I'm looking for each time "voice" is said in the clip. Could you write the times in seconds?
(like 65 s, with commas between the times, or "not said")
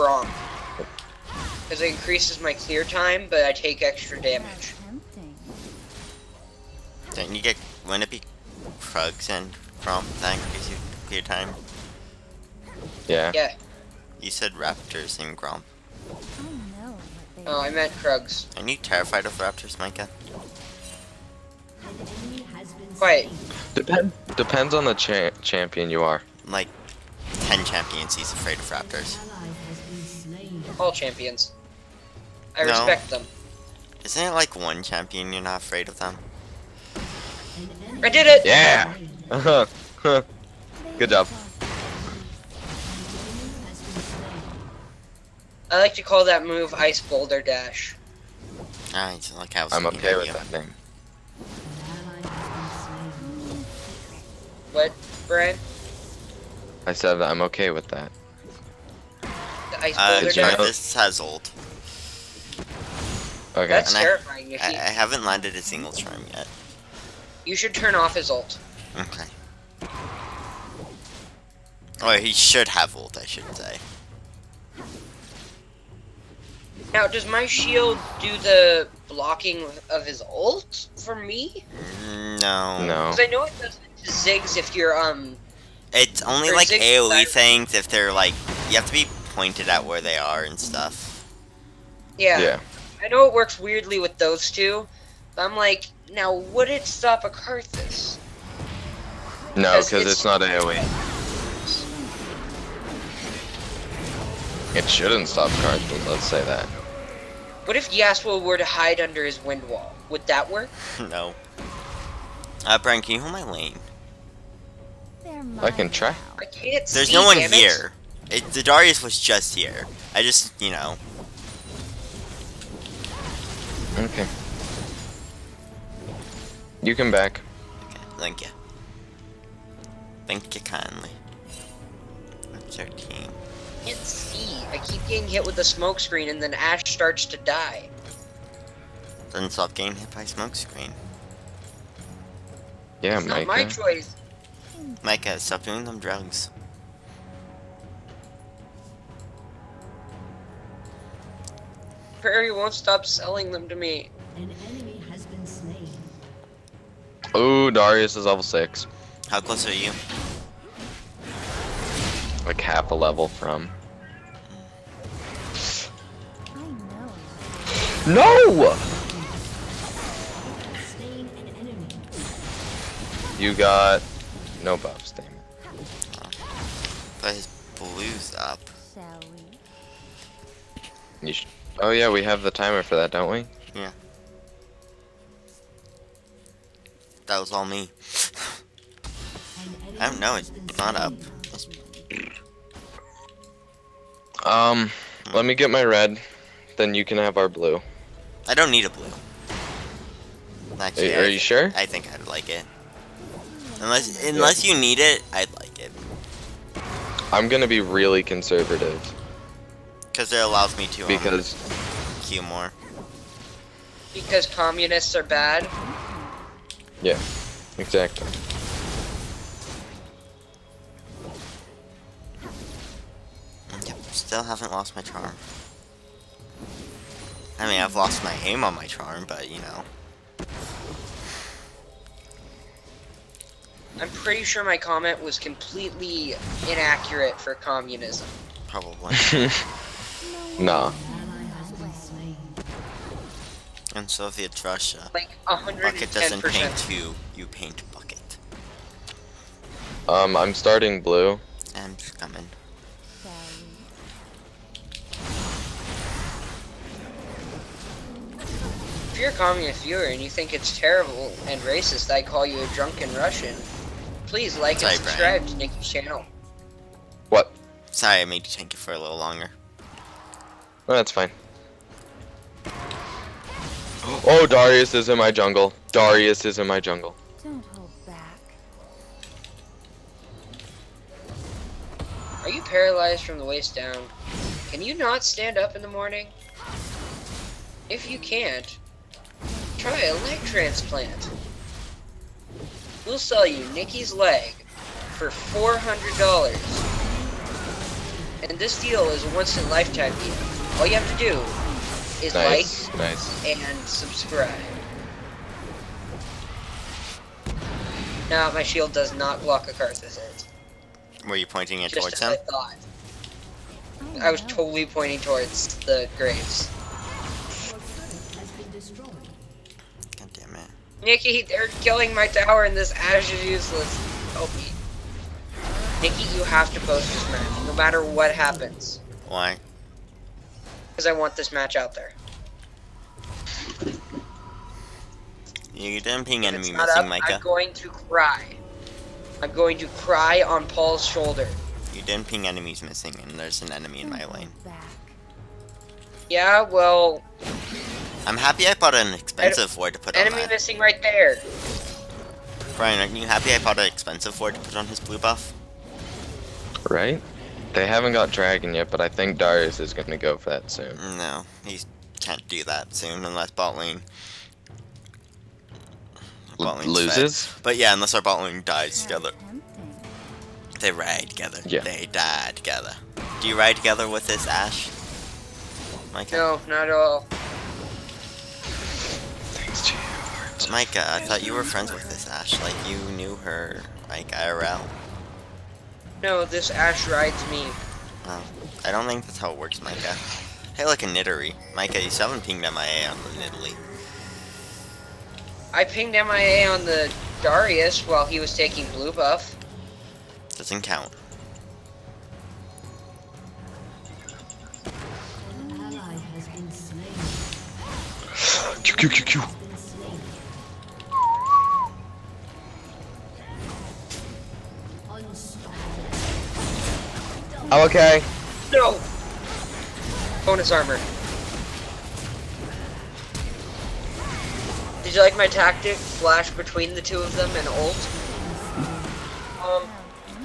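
not said.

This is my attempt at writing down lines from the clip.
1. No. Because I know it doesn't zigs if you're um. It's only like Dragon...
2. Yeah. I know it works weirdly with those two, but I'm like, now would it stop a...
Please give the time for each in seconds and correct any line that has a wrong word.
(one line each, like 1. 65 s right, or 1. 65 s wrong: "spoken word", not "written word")
1. 82 s wrong: "AOE", not "Dragon"
2. 92 s right.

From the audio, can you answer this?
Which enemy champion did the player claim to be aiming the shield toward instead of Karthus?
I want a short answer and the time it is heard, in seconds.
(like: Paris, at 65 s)
Graves, at 315 s.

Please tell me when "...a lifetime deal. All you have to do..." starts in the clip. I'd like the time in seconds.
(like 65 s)
299 s.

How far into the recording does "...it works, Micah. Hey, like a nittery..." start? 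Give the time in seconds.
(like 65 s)
389 s.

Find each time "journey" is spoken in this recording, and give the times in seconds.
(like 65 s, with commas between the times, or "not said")
not said.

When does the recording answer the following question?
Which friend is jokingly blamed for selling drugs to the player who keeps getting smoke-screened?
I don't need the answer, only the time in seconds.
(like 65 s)
152 s.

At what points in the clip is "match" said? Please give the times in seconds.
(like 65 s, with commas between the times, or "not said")
327 s, 331 s.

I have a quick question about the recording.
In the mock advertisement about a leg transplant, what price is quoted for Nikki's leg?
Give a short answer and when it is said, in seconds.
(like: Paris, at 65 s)
$400, at 295 s.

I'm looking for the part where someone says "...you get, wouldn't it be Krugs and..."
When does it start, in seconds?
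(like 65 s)
7 s.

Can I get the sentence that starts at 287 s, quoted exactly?
If you can't, try a leg transplant.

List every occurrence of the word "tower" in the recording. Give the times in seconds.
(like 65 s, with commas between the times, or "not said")
322 s.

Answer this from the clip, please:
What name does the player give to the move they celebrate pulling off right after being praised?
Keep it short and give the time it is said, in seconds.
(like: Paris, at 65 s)
Ice Boulder Dash, at 46 s.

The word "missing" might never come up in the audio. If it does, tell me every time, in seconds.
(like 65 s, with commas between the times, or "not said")
336 s, 342 s, 350 s.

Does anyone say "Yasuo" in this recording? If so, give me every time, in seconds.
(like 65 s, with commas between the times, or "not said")
107 s.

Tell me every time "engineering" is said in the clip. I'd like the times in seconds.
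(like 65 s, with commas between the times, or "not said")
not said.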